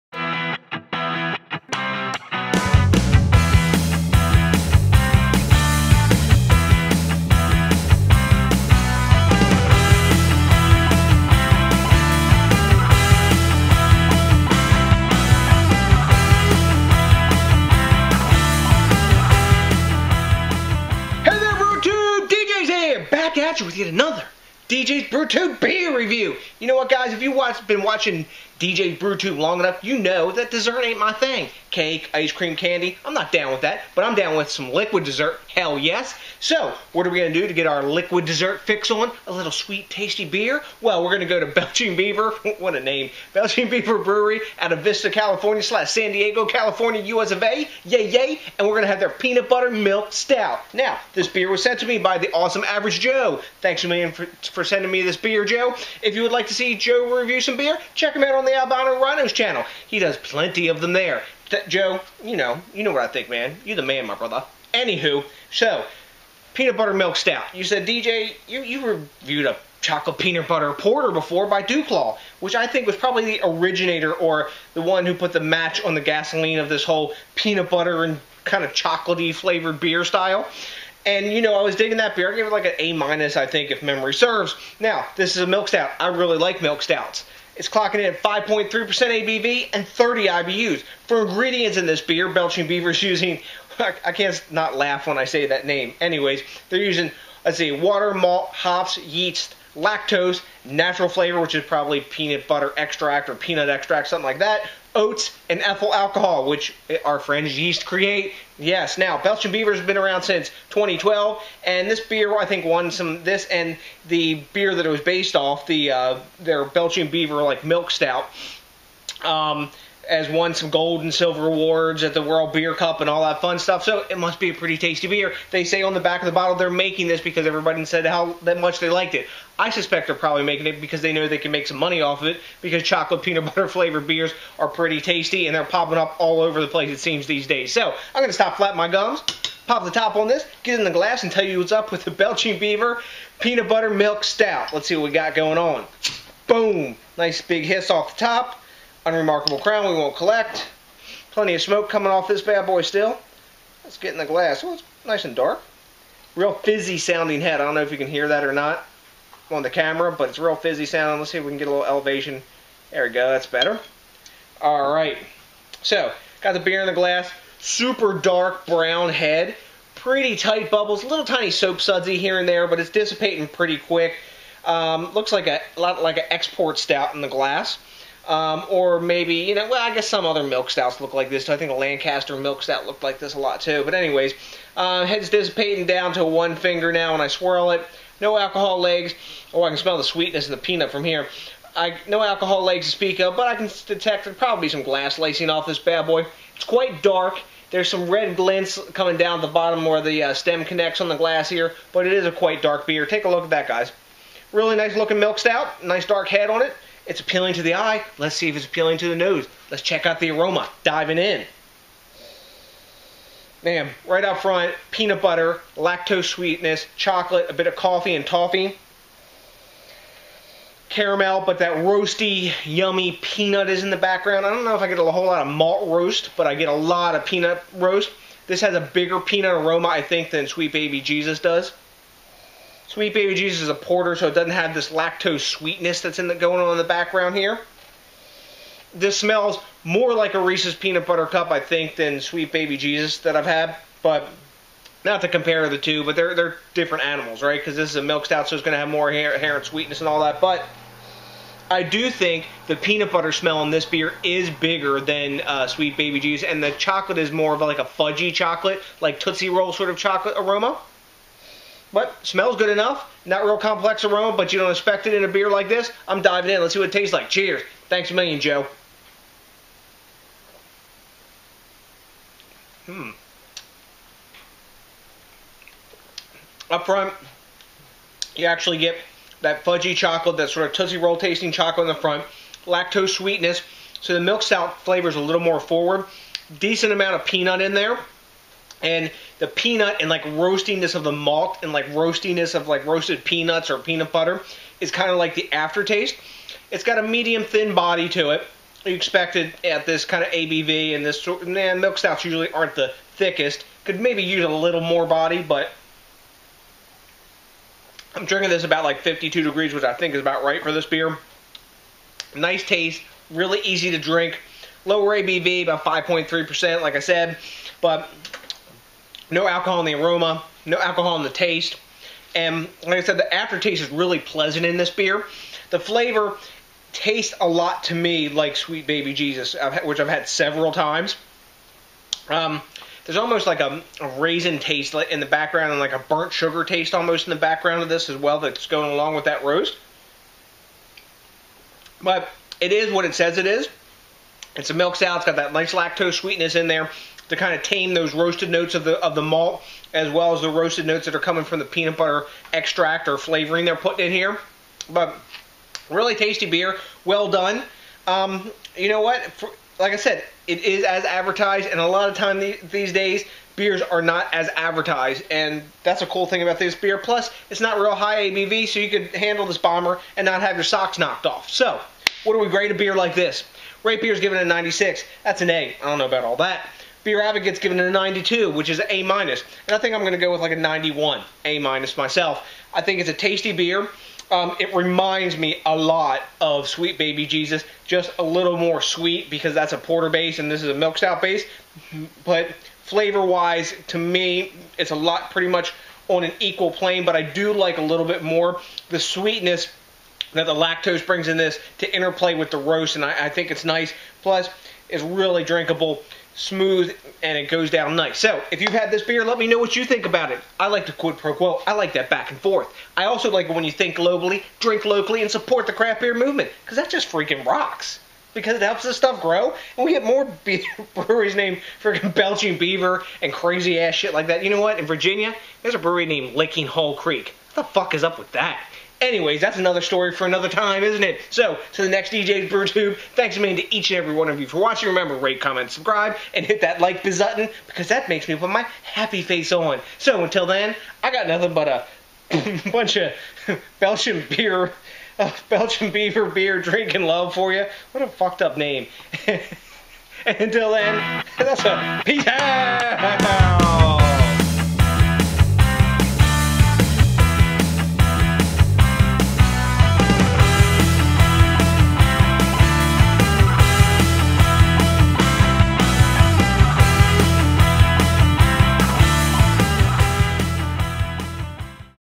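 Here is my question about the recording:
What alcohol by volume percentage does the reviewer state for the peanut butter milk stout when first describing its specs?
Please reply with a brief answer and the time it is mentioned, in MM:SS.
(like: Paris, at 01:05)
5.3%, at 01:28.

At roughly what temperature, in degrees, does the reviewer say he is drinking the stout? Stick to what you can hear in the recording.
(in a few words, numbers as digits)
52.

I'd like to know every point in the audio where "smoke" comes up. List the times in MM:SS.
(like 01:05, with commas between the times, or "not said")
02:31.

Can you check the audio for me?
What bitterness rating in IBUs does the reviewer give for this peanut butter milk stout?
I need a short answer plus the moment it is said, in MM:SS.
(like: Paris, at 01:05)
30, at 01:29.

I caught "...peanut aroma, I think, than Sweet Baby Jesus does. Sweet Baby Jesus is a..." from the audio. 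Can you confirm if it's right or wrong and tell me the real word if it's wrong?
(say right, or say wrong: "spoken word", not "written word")
right.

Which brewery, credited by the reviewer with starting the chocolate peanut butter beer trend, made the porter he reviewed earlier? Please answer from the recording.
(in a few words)
DuClaw.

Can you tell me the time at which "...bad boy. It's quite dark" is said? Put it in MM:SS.
03:15.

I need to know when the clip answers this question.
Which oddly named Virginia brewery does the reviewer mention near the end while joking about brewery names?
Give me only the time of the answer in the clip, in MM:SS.
07:06.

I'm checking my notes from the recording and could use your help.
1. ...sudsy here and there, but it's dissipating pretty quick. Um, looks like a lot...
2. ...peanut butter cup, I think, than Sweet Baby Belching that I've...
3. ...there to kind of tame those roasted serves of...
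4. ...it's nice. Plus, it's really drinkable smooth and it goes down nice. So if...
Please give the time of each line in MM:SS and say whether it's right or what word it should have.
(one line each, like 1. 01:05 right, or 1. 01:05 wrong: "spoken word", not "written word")
1. 02:51 right
2. 04:00 wrong: "Jesus", not "Belching"
3. 05:46 wrong: "notes", not "serves"
4. 06:43 right.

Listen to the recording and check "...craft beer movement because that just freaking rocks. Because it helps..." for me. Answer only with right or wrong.
right.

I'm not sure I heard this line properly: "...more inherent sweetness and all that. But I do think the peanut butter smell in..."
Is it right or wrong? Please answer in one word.
right.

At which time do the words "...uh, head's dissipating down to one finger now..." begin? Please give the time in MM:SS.
03:04.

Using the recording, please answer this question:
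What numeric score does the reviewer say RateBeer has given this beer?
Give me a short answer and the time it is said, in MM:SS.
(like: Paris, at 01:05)
96, at 06:14.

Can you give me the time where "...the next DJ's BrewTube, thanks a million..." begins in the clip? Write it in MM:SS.
07:11.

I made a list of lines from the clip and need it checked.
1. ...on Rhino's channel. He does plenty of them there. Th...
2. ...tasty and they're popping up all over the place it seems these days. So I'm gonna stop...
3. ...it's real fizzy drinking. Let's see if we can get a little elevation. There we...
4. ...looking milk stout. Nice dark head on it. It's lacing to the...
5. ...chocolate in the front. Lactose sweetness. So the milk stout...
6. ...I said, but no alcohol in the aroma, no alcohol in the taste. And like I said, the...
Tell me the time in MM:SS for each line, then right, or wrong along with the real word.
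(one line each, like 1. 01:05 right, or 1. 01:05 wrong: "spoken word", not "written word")
1. 00:58 right
2. 02:15 right
3. 02:40 wrong: "sounding", not "drinking"
4. 03:24 wrong: "appealing", not "lacing"
5. 04:41 right
6. 05:16 right.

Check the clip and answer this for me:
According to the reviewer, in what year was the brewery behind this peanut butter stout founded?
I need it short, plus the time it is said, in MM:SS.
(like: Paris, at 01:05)
2012, at 01:50.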